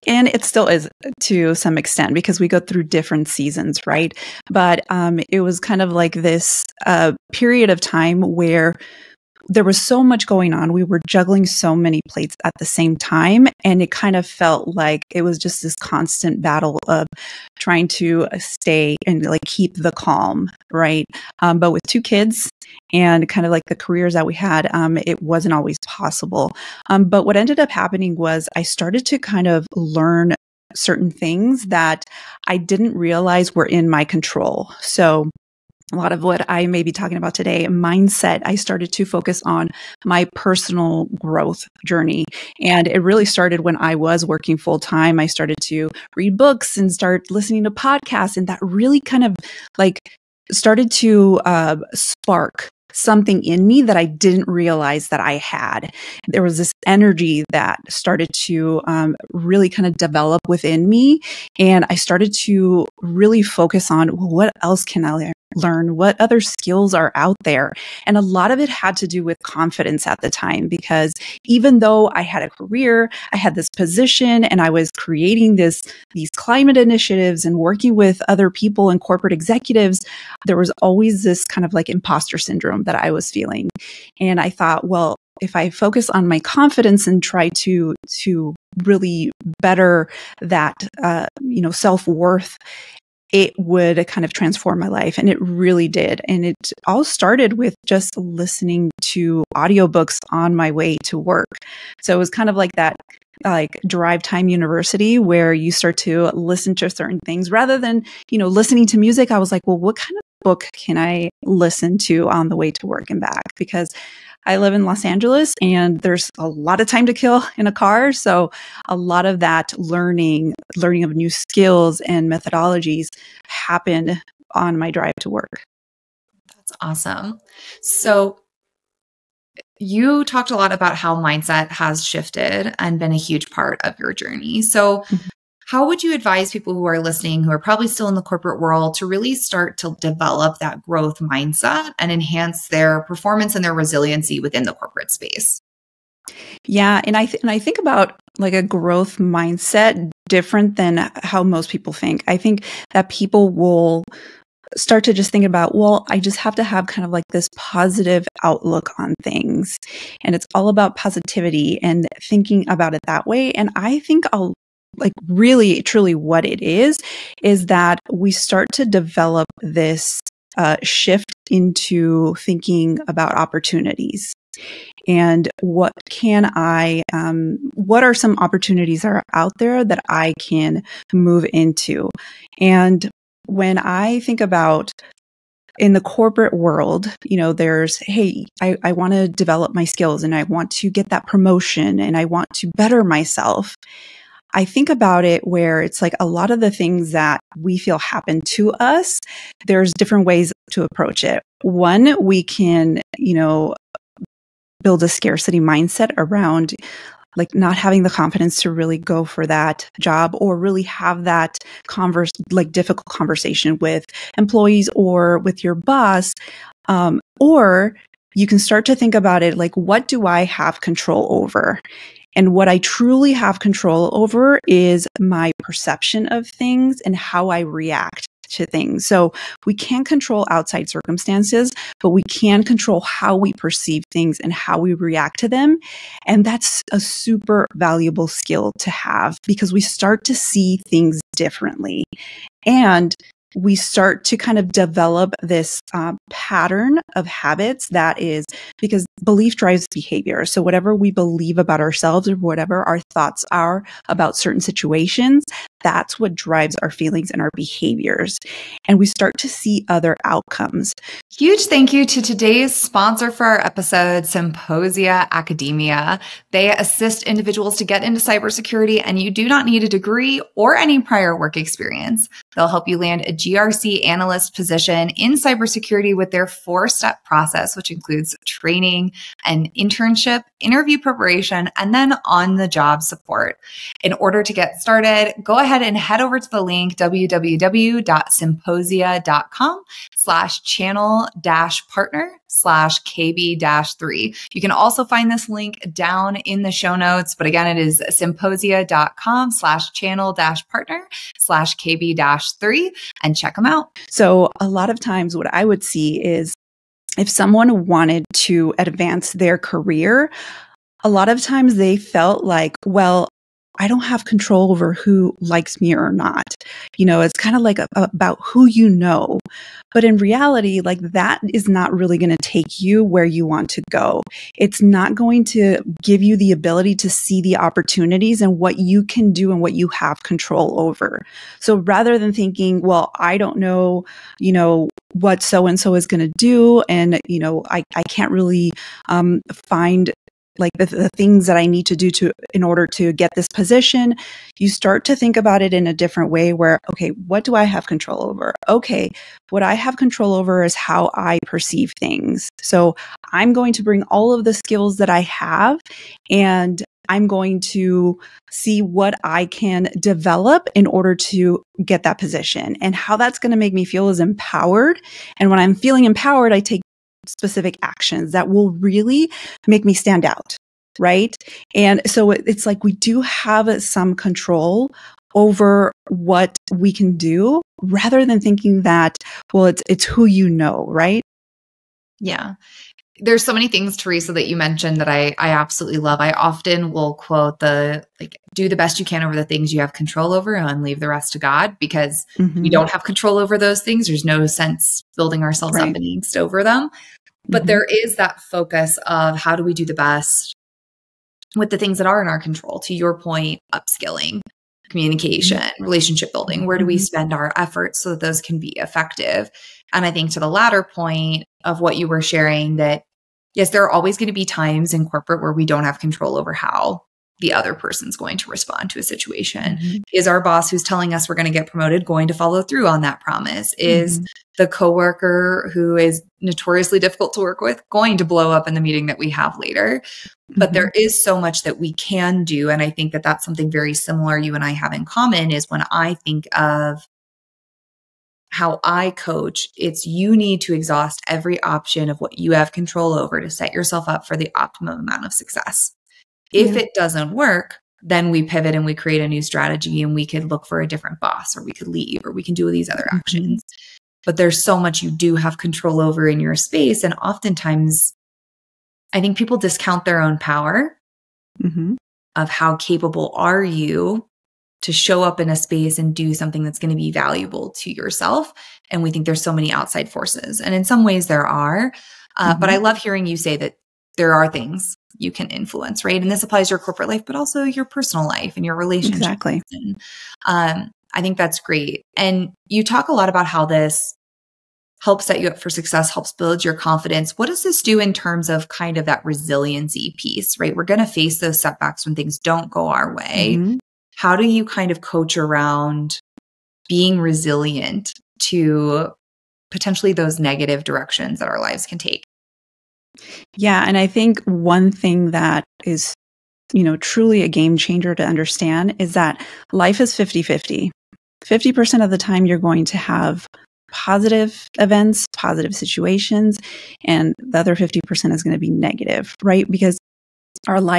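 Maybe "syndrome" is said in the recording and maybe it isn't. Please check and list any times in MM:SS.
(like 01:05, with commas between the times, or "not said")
01:22.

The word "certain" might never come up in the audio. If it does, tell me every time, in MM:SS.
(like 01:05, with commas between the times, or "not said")
00:30, 01:46, 04:14.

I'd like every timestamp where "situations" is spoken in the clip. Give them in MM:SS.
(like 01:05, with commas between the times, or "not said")
04:14, 06:59, 08:35.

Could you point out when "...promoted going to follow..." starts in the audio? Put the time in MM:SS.
07:01.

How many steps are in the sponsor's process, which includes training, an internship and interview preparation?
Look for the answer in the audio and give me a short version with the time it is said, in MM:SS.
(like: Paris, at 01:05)
4, at 04:36.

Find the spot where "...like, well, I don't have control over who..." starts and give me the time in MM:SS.
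05:12.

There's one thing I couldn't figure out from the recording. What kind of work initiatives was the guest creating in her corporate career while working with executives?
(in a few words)
climate initiatives.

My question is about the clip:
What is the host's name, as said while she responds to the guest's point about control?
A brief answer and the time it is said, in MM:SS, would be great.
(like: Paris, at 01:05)
Teresa, at 06:23.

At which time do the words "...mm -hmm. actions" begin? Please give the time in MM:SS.
07:33.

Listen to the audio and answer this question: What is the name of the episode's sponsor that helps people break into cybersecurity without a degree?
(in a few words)
Symposia Academia.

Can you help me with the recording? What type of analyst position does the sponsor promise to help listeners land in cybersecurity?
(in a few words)
GRC analyst.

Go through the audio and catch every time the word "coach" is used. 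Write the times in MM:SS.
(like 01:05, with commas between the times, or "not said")
07:19, 08:15.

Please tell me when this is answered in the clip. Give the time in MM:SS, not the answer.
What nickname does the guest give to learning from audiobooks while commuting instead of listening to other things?
01:43.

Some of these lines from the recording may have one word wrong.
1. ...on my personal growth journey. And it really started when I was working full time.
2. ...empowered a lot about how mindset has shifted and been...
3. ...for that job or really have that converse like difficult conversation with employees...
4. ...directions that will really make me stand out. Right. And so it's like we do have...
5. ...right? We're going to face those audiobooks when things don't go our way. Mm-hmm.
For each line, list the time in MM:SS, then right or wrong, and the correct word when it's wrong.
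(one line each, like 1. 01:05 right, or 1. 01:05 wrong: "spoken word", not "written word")
1. 00:39 right
2. 02:10 wrong: "talked", not "empowered"
3. 03:29 right
4. 06:07 wrong: "actions", not "directions"
5. 08:10 wrong: "setbacks", not "audiobooks".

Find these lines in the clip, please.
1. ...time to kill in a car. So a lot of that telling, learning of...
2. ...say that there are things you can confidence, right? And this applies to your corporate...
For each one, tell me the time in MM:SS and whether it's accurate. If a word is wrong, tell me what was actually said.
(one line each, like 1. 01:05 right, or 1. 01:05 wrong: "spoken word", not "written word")
1. 01:56 wrong: "learning", not "telling"
2. 07:53 wrong: "influence", not "confidence".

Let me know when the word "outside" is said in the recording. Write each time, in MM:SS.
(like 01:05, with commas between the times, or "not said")
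03:50, 07:49.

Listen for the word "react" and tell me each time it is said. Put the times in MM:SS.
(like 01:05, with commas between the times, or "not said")
03:47, 03:54.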